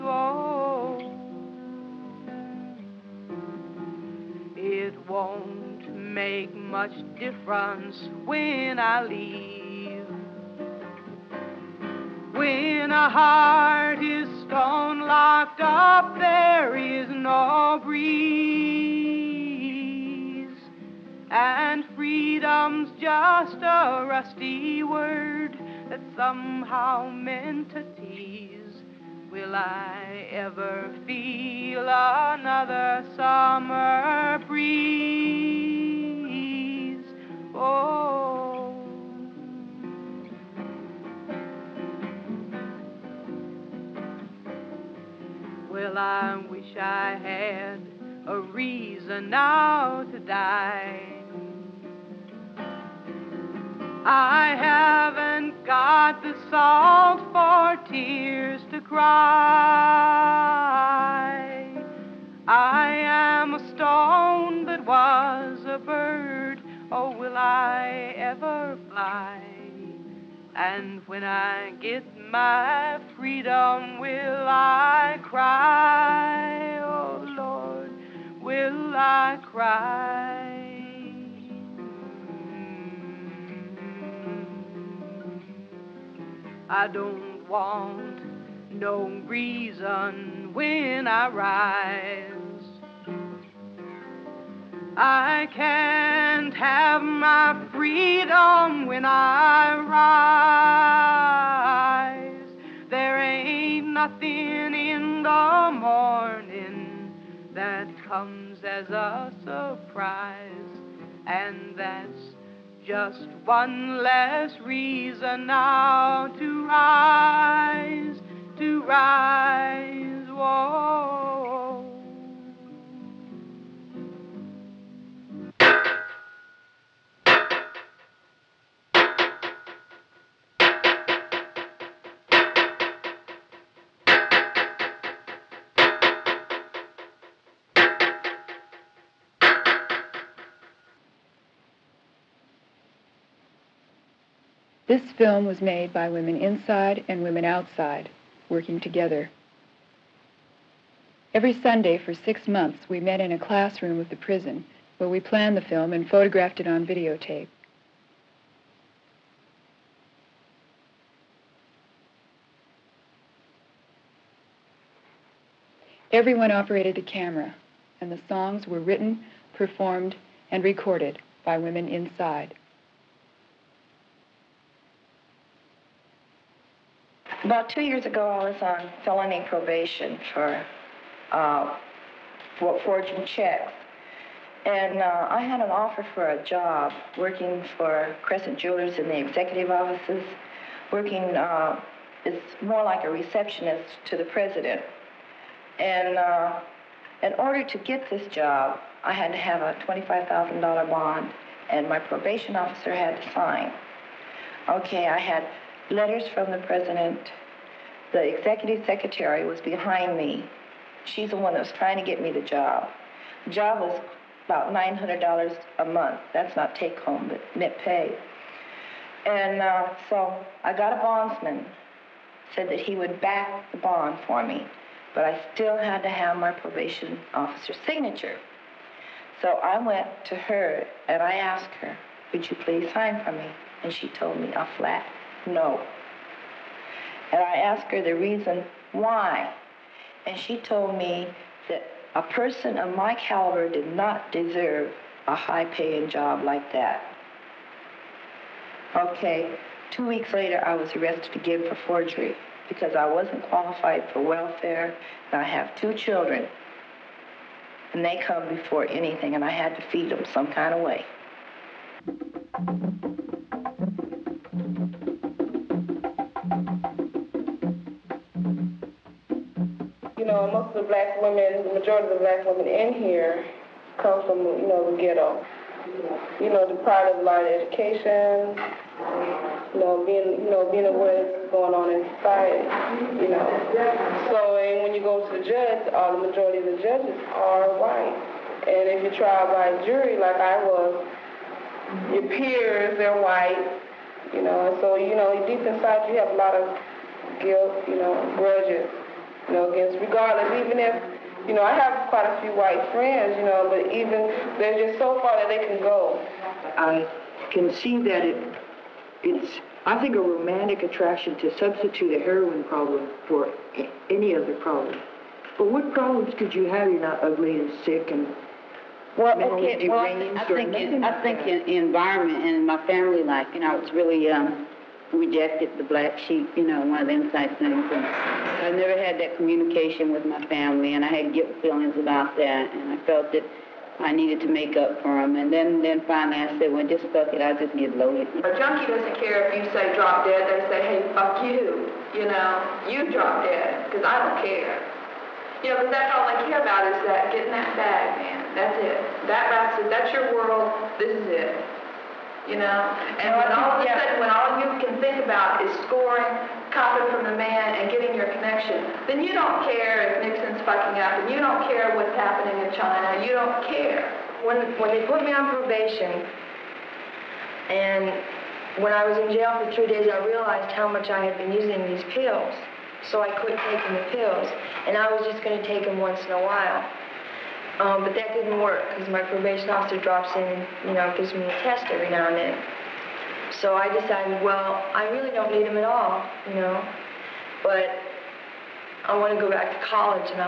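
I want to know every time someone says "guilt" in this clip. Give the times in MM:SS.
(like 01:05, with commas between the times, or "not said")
04:57, 05:31.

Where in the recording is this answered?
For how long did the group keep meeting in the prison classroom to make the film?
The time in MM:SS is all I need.
02:32.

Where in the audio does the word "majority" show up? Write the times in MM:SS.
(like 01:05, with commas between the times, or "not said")
04:31, 04:46.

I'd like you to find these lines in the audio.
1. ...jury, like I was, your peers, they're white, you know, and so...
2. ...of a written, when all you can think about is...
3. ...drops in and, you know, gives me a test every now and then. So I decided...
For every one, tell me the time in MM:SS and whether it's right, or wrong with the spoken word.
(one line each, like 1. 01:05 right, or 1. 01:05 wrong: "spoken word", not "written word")
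1. 04:49 right
2. 05:53 wrong: "sudden", not "written"
3. 06:19 right.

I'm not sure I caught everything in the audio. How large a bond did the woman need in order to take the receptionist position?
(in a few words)
$25,000.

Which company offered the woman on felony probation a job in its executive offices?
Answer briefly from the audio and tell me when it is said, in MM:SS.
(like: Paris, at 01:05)
Crescent Jewelers, at 03:08.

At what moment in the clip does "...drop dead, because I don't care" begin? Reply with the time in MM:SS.
05:43.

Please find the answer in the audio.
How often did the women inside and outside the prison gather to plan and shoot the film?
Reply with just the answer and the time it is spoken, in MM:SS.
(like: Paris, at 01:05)
Every Sunday, at 02:31.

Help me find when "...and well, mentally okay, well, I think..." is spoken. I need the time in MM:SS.
05:18.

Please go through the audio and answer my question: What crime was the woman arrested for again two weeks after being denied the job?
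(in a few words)
Forgery.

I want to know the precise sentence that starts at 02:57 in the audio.
About two years ago, I was on felony probation for uh, for forging checks.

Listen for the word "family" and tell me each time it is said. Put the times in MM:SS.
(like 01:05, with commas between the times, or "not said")
05:22, 05:30.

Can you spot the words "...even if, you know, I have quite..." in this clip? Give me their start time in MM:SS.
05:00.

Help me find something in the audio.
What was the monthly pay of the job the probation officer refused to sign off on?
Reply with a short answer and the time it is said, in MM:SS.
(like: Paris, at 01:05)
$900, at 03:34.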